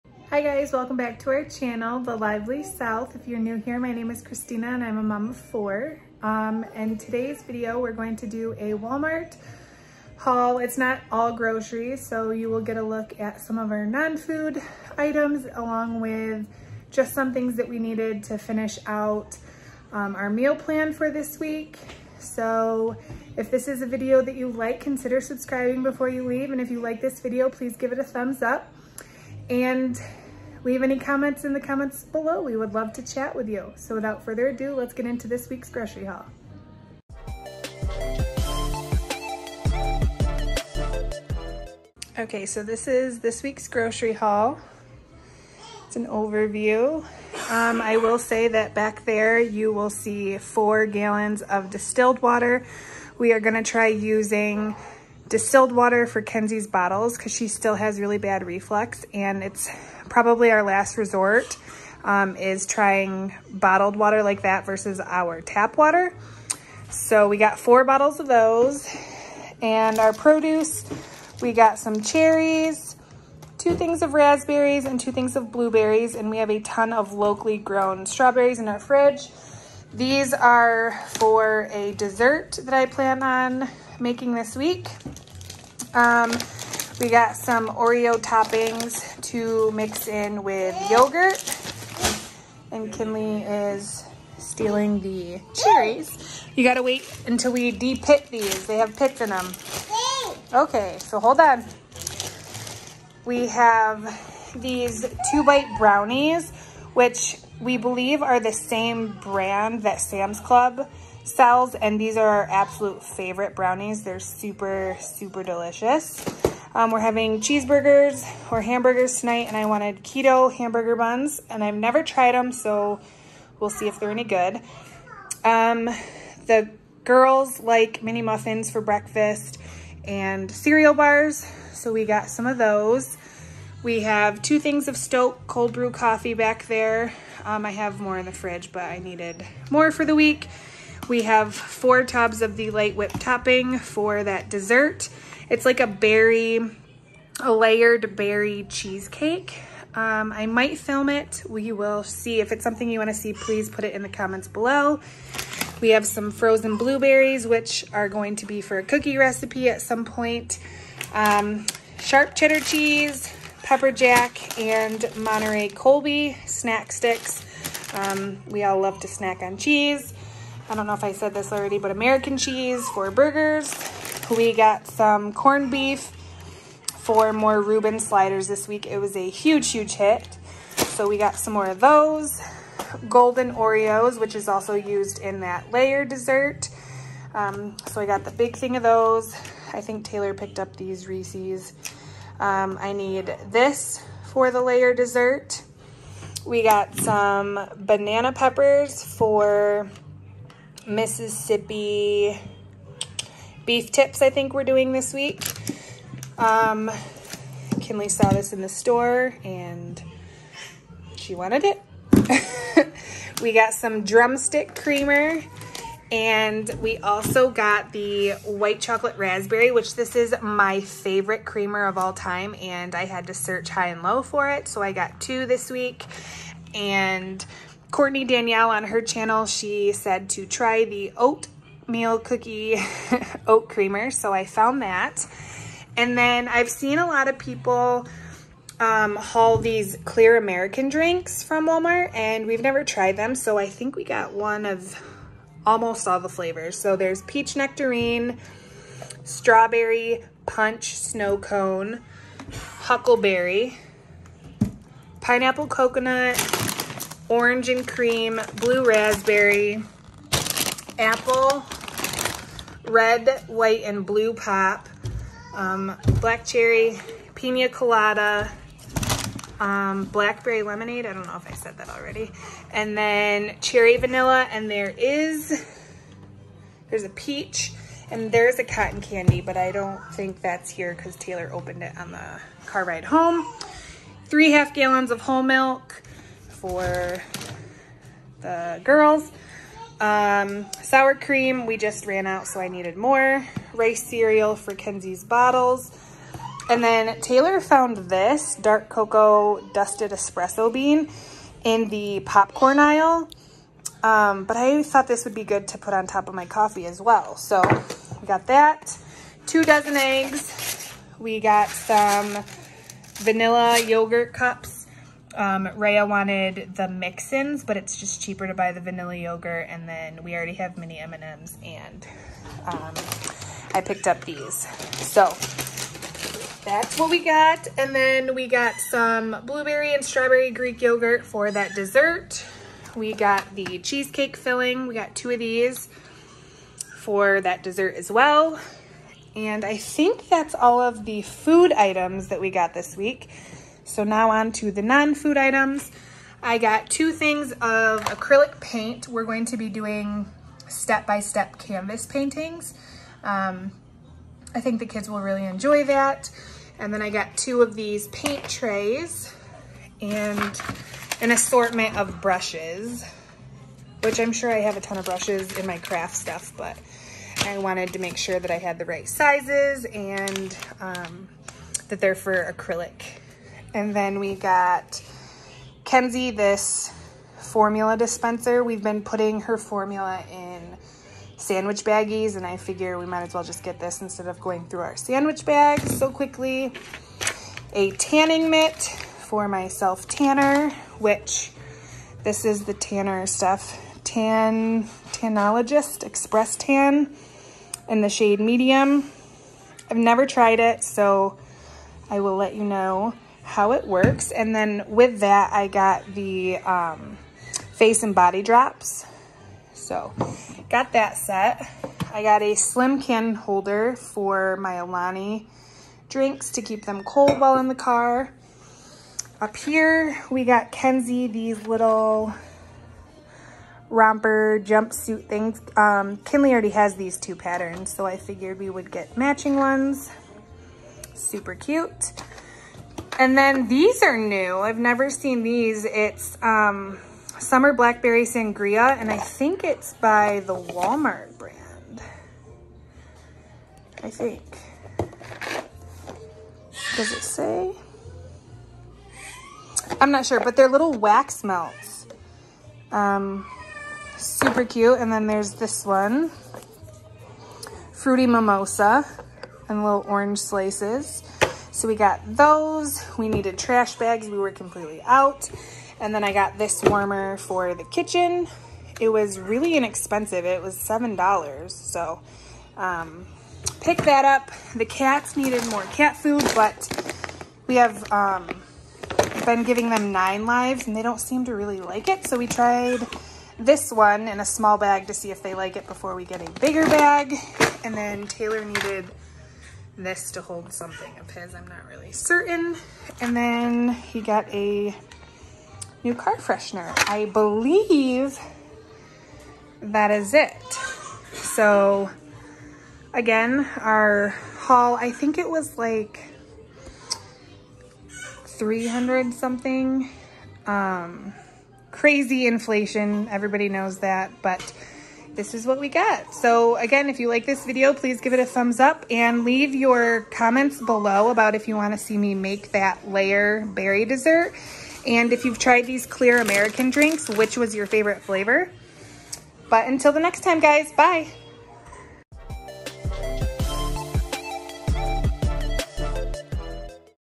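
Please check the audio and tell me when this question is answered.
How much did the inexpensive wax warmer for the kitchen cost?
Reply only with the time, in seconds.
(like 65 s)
470 s.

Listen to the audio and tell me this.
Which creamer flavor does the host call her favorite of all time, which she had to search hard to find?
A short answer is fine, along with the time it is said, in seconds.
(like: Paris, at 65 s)
white chocolate raspberry, at 218 s.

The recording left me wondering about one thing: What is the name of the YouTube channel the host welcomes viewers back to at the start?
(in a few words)
The Lively South.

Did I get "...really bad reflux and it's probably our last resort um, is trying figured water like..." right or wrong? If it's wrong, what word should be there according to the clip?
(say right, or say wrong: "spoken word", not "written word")
wrong: "bottled", not "figured".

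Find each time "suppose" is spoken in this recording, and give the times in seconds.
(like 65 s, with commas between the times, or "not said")
not said.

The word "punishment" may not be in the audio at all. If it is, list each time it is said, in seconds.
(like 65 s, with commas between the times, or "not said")
not said.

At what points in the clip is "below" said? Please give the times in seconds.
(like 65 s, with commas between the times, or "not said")
32 s, 154 s, 520 s.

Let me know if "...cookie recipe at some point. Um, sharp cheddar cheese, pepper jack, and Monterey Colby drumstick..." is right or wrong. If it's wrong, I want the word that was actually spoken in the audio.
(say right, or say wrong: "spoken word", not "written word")
wrong: "snack", not "drumstick".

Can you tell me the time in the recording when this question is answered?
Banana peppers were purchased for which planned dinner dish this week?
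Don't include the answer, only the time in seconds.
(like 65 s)
200 s.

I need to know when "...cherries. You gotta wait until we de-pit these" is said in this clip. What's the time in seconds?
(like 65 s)
95 s.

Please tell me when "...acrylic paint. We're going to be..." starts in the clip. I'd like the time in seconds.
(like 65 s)
348 s.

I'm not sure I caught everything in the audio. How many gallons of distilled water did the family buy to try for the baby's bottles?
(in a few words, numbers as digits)
4.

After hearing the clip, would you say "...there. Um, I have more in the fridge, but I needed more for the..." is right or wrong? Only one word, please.
right.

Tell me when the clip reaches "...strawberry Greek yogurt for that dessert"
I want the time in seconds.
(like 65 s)
330 s.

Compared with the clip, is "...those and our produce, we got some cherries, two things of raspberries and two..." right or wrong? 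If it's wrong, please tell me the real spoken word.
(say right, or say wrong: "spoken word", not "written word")
right.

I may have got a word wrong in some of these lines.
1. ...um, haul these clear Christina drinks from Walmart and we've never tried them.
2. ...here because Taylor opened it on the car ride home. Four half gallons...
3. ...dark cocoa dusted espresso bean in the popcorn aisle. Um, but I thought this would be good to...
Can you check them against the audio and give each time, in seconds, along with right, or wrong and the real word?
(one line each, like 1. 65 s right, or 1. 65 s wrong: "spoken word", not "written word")
1. 238 s wrong: "American", not "Christina"
2. 280 s wrong: "Three", not "Four"
3. 298 s right.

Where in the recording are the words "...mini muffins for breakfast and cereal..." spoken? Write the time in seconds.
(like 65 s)
128 s.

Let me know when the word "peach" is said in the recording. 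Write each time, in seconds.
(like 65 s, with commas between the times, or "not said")
247 s, 277 s.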